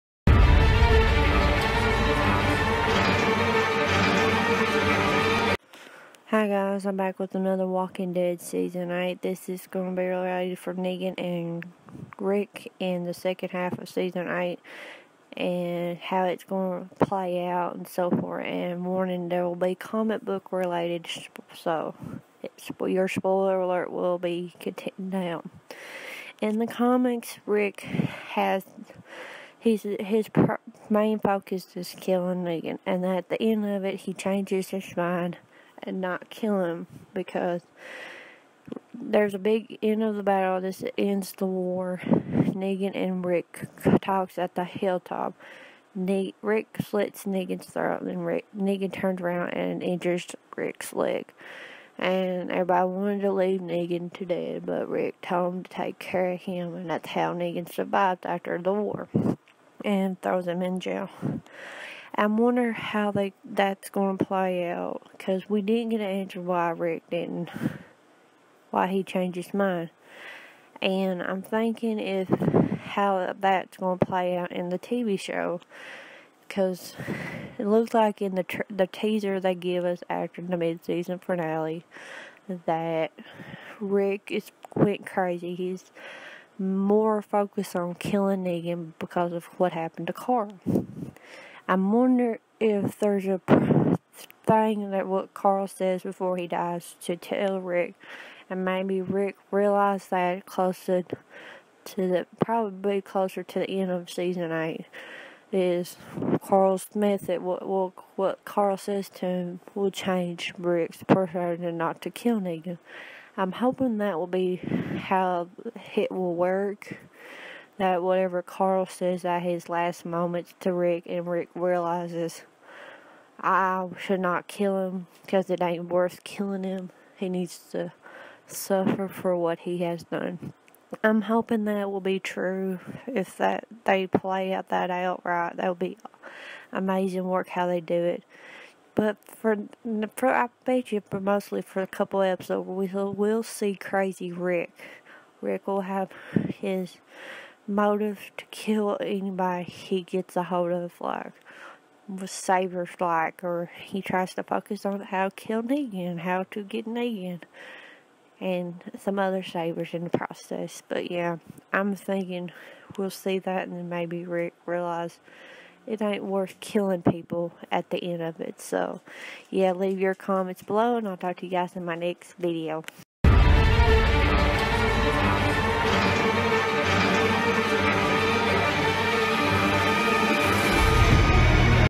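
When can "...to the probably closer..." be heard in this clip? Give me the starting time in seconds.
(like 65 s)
101 s.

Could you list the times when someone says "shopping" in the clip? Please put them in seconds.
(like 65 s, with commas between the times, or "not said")
not said.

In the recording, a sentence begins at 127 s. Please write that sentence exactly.
He needs to suffer for what he has done.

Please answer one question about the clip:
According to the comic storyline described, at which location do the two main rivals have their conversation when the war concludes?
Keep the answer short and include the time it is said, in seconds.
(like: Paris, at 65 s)
Hilltop, at 44 s.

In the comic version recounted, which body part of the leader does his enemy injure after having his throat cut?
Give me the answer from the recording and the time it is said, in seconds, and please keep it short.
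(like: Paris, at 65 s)
Leg, at 50 s.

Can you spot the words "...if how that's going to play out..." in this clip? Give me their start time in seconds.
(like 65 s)
71 s.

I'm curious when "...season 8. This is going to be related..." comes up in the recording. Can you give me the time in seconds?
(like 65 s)
8 s.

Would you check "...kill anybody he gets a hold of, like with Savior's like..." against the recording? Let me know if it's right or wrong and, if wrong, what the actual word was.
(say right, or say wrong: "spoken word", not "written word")
right.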